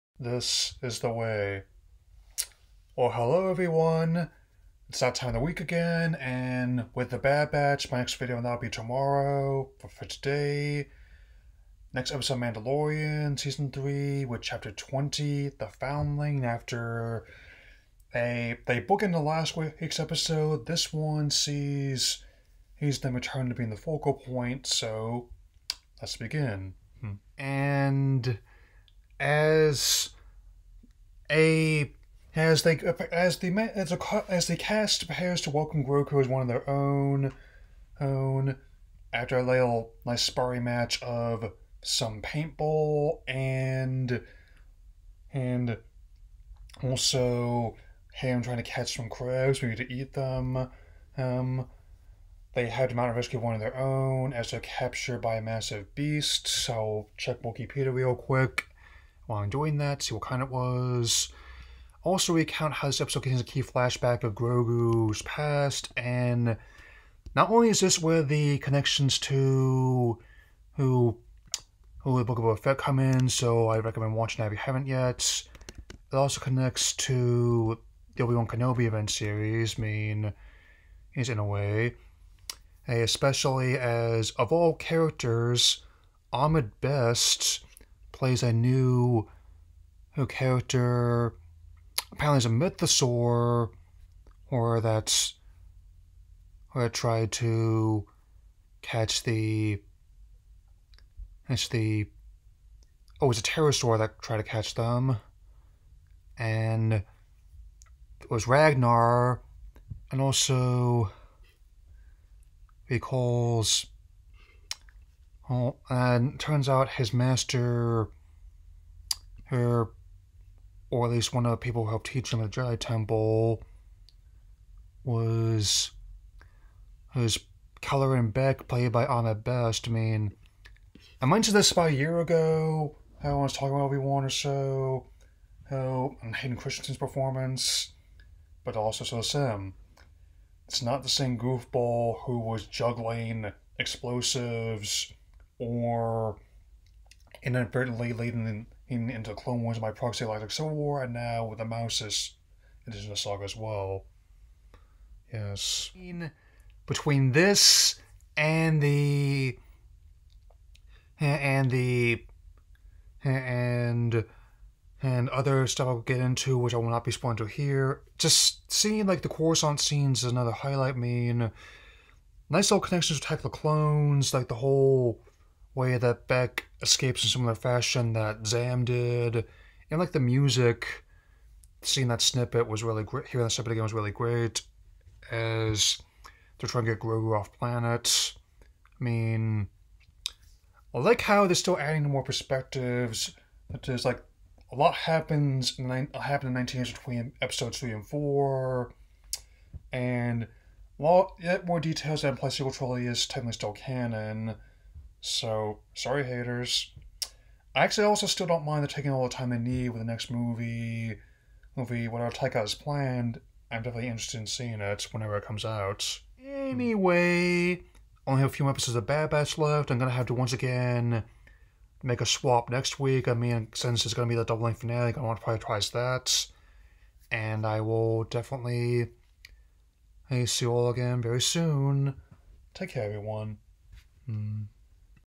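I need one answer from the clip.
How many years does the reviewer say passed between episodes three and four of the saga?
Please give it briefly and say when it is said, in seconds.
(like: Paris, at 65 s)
19, at 196 s.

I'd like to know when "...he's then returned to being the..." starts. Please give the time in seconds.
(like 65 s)
22 s.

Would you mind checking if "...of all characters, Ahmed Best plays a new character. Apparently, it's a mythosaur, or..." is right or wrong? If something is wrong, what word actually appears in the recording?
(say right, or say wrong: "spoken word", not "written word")
right.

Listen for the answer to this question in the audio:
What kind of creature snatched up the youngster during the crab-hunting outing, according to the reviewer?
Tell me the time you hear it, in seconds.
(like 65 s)
103 s.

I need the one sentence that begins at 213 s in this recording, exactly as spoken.
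I'm definitely interested in seeing it whenever it comes out.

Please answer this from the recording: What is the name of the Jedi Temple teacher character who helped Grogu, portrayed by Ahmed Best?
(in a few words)
Kelleran Beck.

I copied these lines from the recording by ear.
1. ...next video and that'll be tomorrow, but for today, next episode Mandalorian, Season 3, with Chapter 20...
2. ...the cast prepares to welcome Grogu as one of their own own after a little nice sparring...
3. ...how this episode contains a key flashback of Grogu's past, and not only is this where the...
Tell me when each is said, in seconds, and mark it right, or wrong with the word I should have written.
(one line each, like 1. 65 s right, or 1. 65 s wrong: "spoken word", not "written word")
1. 7 s right
2. 34 s right
3. 62 s right.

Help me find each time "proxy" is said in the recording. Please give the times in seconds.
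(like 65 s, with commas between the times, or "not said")
149 s.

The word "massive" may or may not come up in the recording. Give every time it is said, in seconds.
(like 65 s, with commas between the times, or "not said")
55 s.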